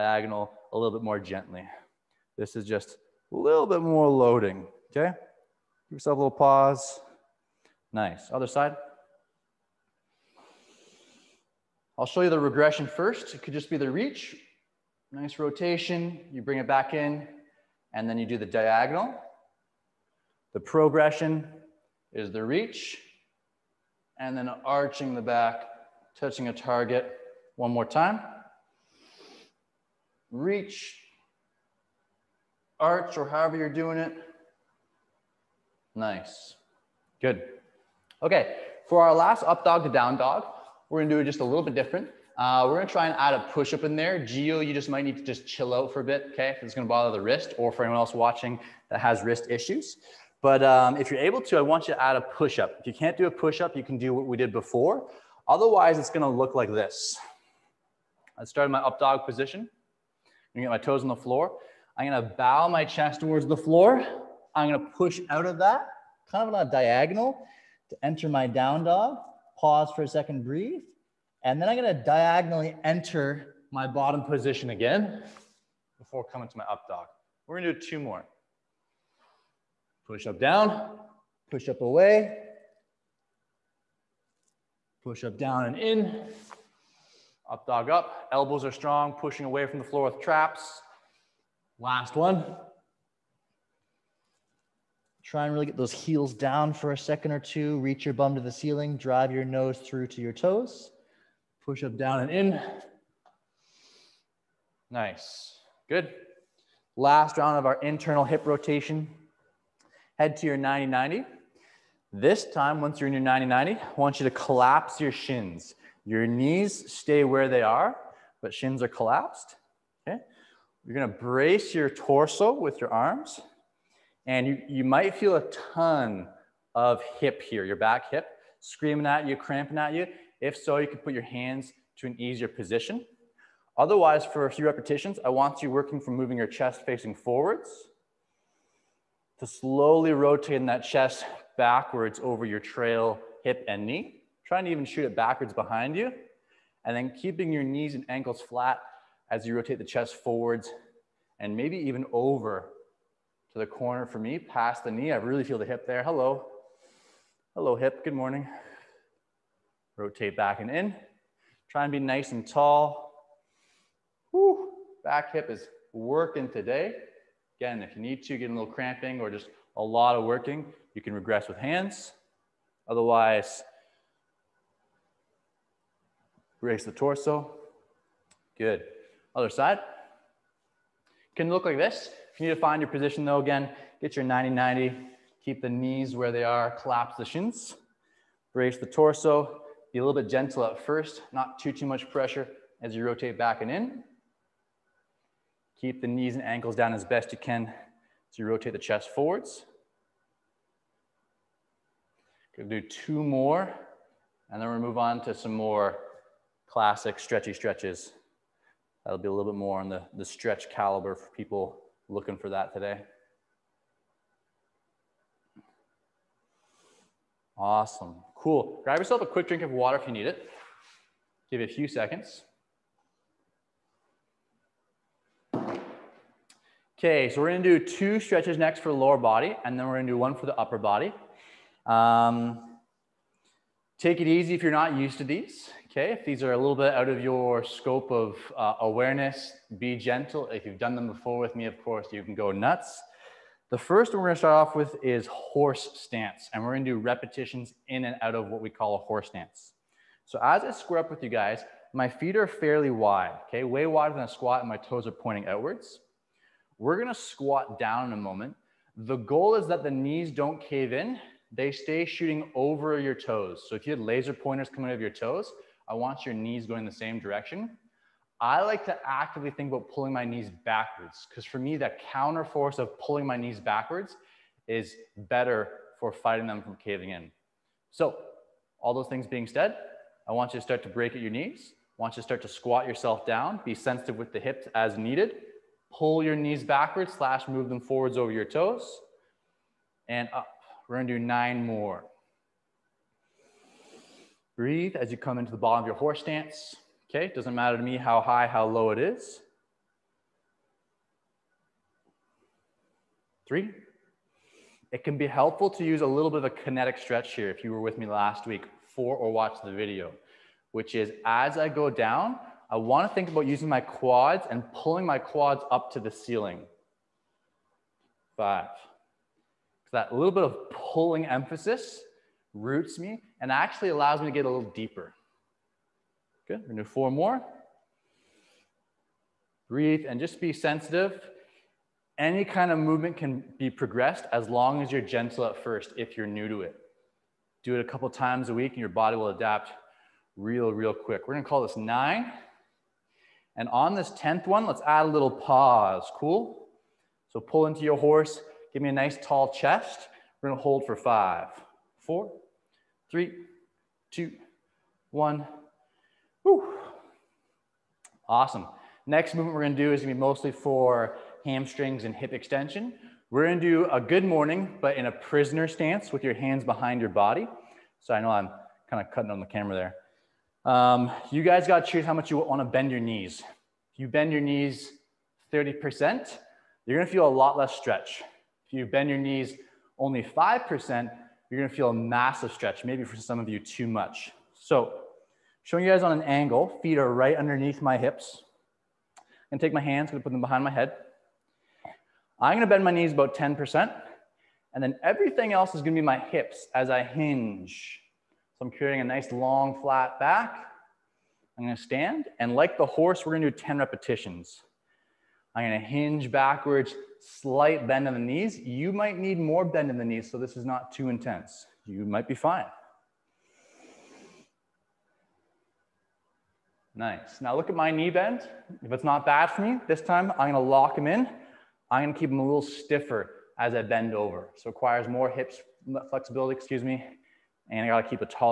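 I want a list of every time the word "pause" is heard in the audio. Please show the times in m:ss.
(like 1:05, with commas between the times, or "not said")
0:06, 1:09, 5:45.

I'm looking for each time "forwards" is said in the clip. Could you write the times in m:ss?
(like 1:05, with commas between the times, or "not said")
2:17, 2:30, 3:19, 4:47.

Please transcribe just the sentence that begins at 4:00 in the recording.
If you've done them before with me, of course, you can go nuts.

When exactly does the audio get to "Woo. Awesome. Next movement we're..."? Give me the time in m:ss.
5:56.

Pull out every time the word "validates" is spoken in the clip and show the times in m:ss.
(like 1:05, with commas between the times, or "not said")
not said.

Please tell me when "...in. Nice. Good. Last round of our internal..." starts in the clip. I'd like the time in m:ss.
1:42.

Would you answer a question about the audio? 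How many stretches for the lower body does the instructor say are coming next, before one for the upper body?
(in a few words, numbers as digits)
2.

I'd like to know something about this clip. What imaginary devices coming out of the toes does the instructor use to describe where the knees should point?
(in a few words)
laser pointers.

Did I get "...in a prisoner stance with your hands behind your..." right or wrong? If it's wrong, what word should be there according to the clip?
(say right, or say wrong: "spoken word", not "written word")
right.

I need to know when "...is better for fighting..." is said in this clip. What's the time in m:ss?
4:34.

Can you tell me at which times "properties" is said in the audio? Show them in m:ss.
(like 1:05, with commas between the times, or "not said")
not said.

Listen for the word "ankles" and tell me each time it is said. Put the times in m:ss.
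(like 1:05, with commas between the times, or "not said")
2:28, 3:16.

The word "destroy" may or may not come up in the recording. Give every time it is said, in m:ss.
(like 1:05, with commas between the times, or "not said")
not said.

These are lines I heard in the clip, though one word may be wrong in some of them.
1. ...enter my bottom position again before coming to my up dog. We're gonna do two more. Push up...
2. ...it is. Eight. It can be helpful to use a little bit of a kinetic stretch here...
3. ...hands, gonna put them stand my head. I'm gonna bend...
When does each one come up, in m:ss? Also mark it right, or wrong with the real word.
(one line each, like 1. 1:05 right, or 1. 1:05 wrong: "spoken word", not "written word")
1. 1:12 right
2. 4:58 wrong: "Three", not "Eight"
3. 6:29 wrong: "behind", not "stand".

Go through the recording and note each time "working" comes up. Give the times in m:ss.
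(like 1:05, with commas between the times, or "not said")
2:15, 2:45, 2:50.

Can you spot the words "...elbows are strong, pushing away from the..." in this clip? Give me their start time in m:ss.
1:28.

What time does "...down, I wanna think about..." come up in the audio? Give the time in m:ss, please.
5:11.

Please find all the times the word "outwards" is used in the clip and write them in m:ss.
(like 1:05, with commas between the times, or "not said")
4:15.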